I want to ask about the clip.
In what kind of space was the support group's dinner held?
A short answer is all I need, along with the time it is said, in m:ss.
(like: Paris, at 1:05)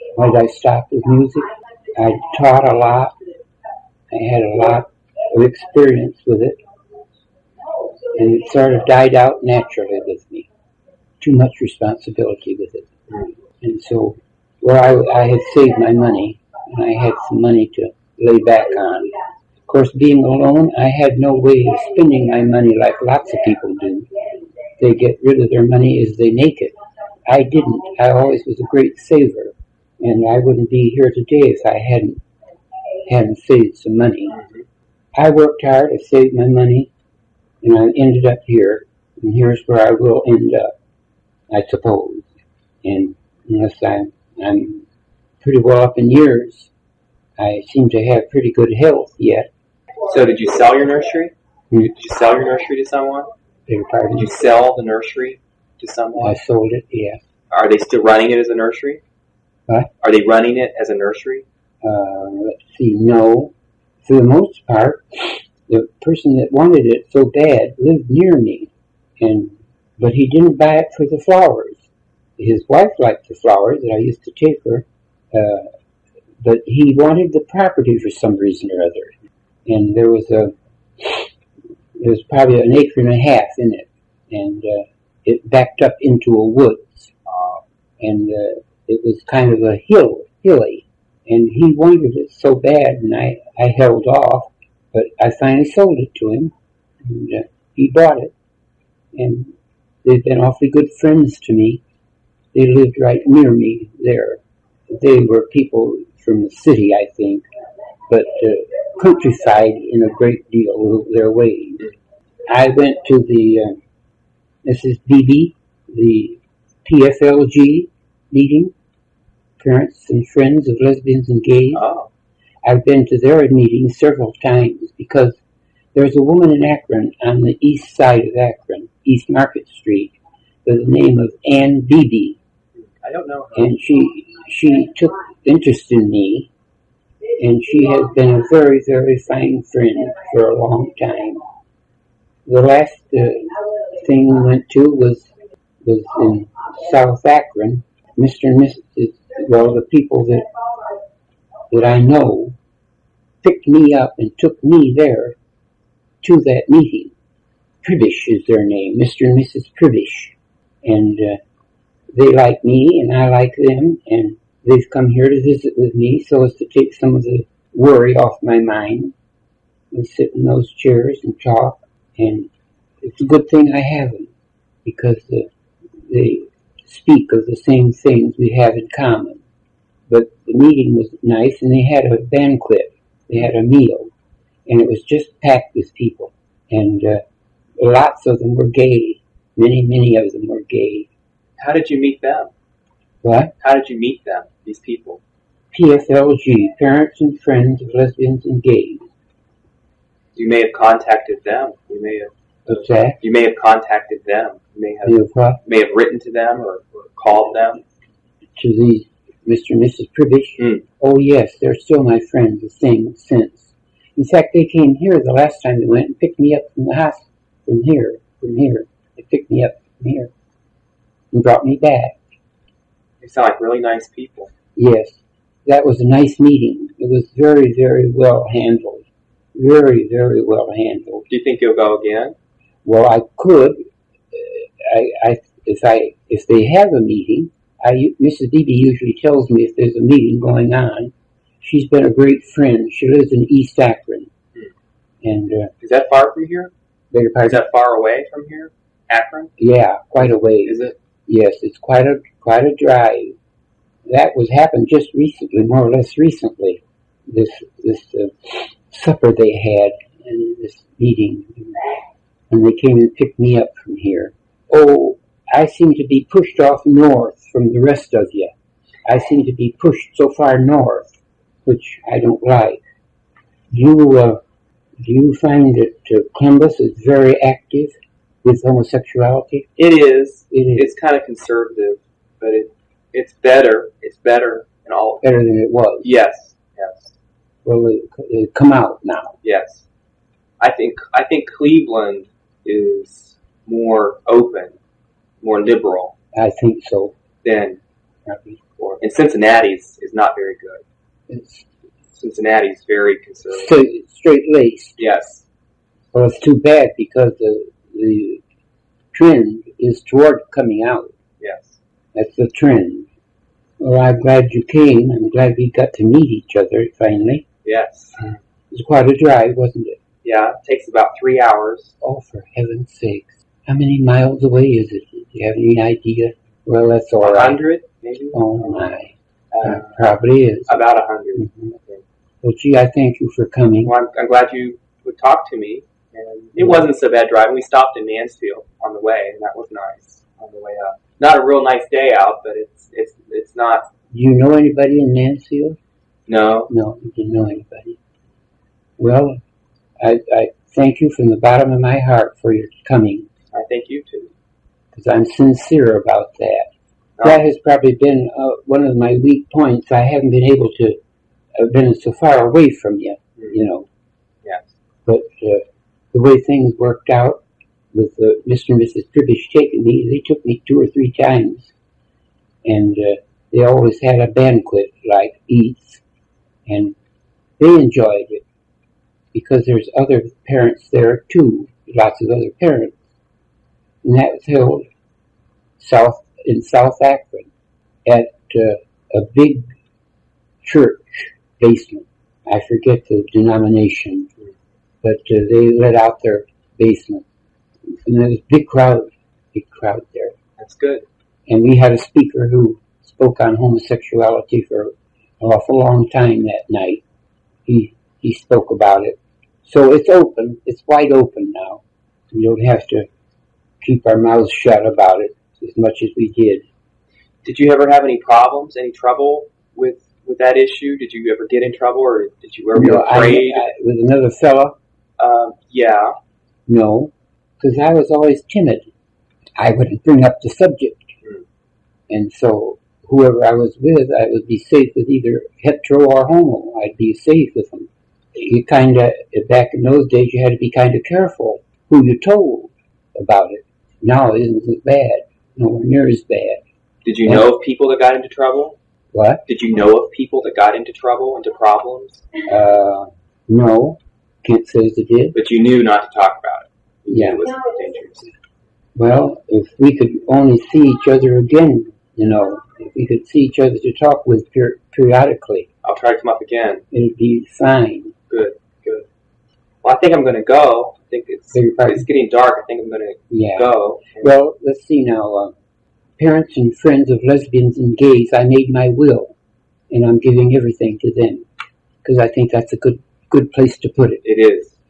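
church basement, at 6:30.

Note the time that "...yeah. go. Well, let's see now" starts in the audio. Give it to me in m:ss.
7:53.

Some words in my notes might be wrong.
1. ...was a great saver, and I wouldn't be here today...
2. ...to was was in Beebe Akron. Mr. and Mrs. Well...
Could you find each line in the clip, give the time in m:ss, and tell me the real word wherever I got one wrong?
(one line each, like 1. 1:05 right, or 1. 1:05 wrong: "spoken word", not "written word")
1. 0:28 right
2. 2:24 wrong: "South", not "Beebe".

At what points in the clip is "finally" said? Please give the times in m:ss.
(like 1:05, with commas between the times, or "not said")
1:35, 5:16.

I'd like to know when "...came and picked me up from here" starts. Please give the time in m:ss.
4:22.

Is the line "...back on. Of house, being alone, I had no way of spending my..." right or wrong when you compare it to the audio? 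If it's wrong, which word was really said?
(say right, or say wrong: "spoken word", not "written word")
wrong: "course", not "house".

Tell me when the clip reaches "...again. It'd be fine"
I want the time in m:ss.
7:46.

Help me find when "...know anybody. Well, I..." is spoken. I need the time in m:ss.
5:47.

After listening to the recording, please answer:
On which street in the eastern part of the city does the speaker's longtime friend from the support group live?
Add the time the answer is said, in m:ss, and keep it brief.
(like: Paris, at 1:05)
East Market Street, at 2:09.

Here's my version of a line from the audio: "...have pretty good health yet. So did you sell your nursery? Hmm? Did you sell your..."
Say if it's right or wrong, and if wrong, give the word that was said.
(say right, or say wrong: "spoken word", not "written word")
right.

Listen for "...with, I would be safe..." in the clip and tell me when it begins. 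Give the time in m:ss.
7:13.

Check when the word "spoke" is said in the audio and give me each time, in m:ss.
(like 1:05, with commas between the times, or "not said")
6:43, 6:48.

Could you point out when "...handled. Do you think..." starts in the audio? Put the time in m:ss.
3:50.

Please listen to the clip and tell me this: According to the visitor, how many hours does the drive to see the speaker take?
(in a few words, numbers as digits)
3 hours.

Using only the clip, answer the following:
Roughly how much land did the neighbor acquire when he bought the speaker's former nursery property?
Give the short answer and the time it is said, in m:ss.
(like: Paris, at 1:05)
1.5 acres, at 1:22.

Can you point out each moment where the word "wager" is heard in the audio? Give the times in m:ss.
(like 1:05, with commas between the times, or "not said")
not said.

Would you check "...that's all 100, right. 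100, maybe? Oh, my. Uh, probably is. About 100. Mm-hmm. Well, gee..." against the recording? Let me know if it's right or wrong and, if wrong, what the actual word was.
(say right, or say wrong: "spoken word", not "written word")
right.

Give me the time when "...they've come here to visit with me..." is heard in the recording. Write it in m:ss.
2:44.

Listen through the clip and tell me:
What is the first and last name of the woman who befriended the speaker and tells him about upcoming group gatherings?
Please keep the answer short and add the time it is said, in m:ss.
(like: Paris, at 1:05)
Ann Beebe, at 2:11.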